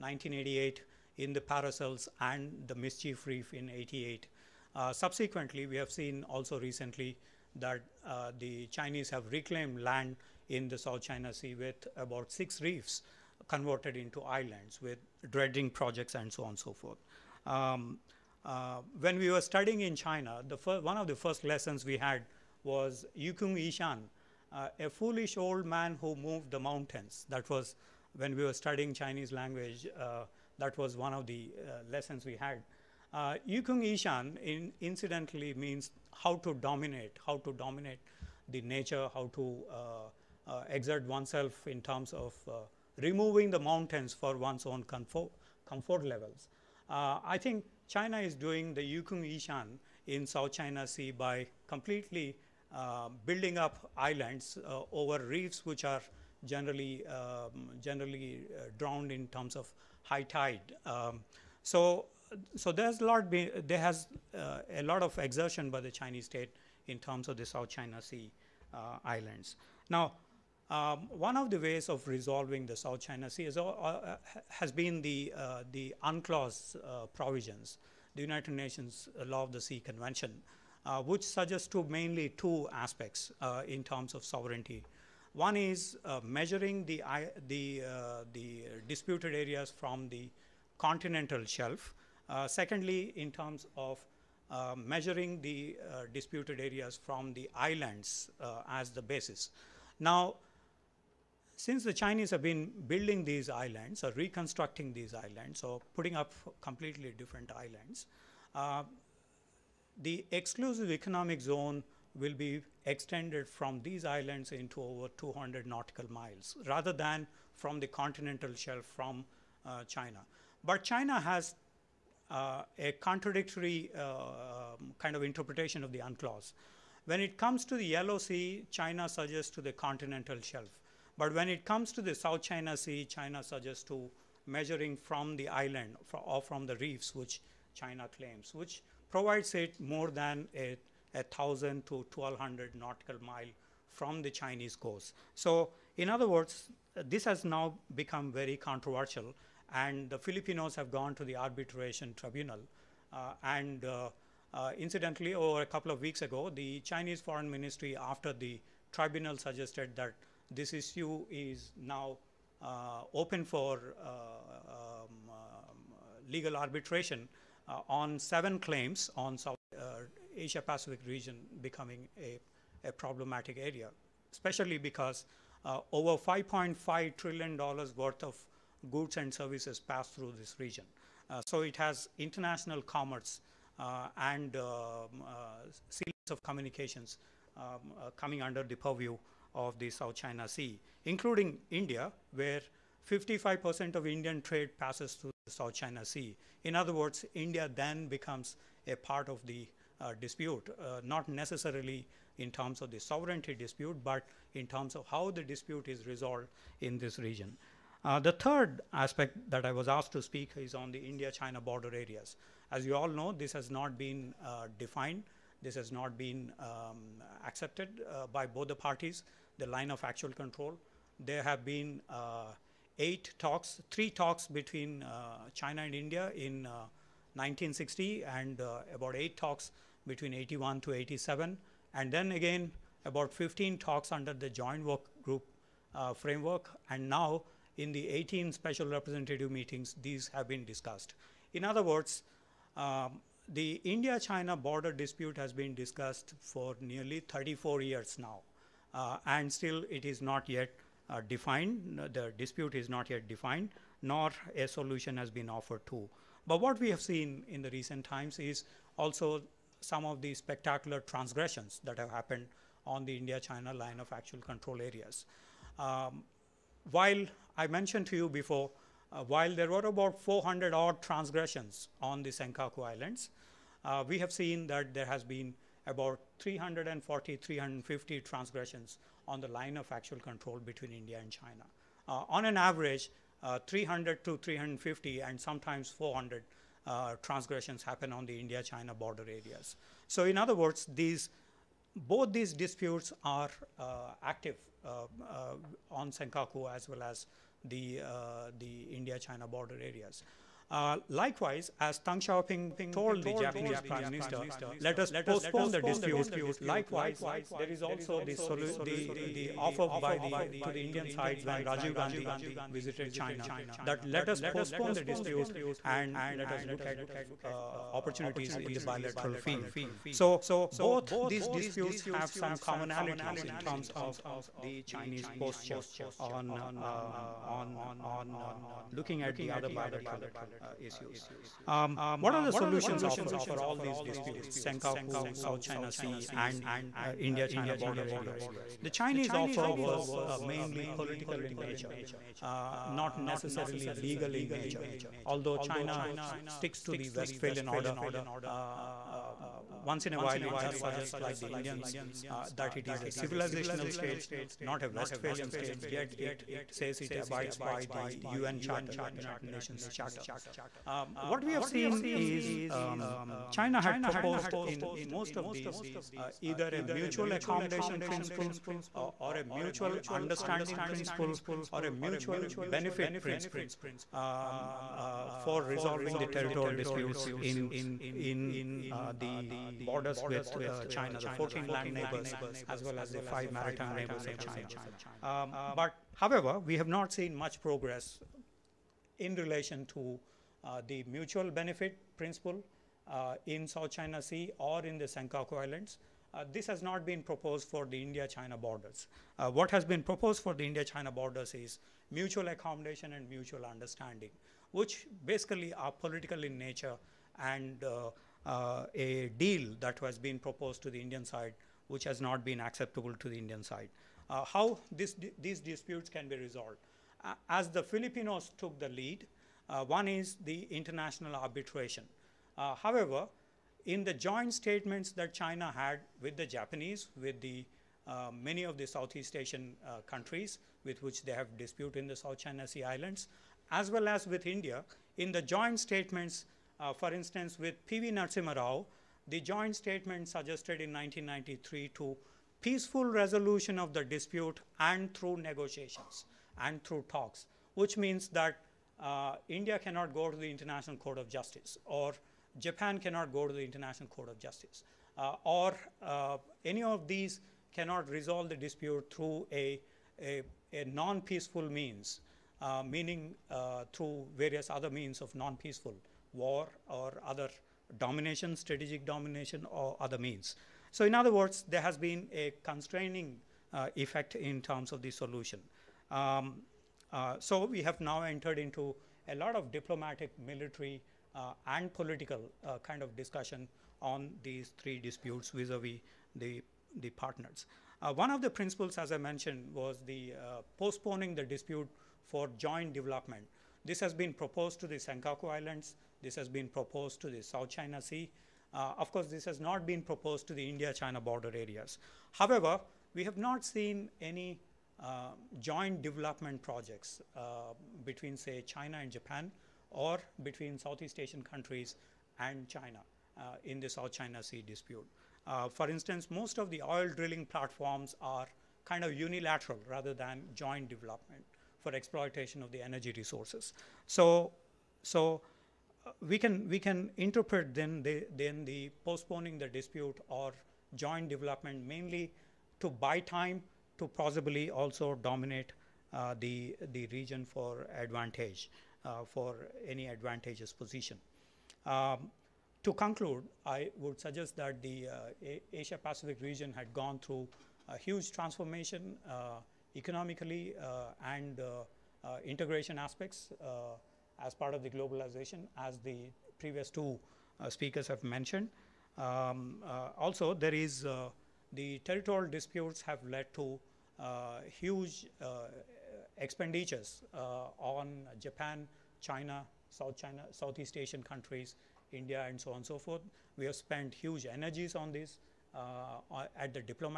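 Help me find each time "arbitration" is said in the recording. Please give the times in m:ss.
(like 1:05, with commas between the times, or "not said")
2:31, 2:46, 7:01.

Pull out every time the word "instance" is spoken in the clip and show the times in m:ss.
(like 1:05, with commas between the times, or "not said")
7:17, 8:35.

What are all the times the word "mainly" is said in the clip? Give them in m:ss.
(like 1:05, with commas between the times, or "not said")
1:21, 5:40, 8:51.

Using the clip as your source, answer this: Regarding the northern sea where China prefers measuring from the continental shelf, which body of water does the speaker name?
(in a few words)
Yellow Sea.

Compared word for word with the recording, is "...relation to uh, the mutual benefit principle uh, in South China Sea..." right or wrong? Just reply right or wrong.
right.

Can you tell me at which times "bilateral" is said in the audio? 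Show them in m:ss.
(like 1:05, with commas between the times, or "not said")
5:18, 5:29.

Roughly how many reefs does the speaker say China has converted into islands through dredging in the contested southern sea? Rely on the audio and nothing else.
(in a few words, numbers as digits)
6.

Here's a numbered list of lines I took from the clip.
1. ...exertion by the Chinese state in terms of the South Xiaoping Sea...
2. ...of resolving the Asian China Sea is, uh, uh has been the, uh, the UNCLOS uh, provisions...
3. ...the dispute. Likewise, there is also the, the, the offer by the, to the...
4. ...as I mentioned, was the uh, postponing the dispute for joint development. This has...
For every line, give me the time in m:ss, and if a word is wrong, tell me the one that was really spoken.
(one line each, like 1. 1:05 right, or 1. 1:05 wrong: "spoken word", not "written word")
1. 1:05 wrong: "China", not "Xiaoping"
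2. 1:11 wrong: "South", not "Asian"
3. 5:05 right
4. 8:09 right.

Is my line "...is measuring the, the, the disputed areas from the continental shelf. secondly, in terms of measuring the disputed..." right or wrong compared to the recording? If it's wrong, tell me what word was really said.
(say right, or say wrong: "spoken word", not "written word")
right.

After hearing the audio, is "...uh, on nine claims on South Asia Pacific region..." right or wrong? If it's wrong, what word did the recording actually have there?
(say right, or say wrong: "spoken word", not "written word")
wrong: "seven", not "nine".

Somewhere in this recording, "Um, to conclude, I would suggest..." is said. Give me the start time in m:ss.
9:01.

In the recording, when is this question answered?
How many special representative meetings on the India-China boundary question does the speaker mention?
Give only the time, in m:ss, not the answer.
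3:58.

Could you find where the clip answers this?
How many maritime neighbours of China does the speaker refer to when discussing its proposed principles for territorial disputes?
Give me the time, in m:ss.
6:23.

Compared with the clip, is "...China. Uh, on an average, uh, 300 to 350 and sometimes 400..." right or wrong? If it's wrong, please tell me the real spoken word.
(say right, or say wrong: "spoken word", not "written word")
right.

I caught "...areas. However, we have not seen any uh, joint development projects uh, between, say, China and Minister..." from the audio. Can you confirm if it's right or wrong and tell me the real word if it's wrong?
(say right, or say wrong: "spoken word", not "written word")
wrong: "Japan", not "Minister".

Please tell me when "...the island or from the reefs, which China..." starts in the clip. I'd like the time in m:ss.
2:15.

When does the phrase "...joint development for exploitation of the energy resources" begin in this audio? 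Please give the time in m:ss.
8:40.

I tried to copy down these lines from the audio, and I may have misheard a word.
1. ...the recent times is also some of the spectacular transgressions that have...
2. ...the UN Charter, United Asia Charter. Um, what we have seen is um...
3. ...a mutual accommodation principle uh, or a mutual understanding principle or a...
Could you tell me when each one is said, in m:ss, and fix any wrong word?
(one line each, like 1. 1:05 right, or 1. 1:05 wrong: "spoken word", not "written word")
1. 4:17 right
2. 5:57 wrong: "Nations", not "Asia"
3. 6:06 right.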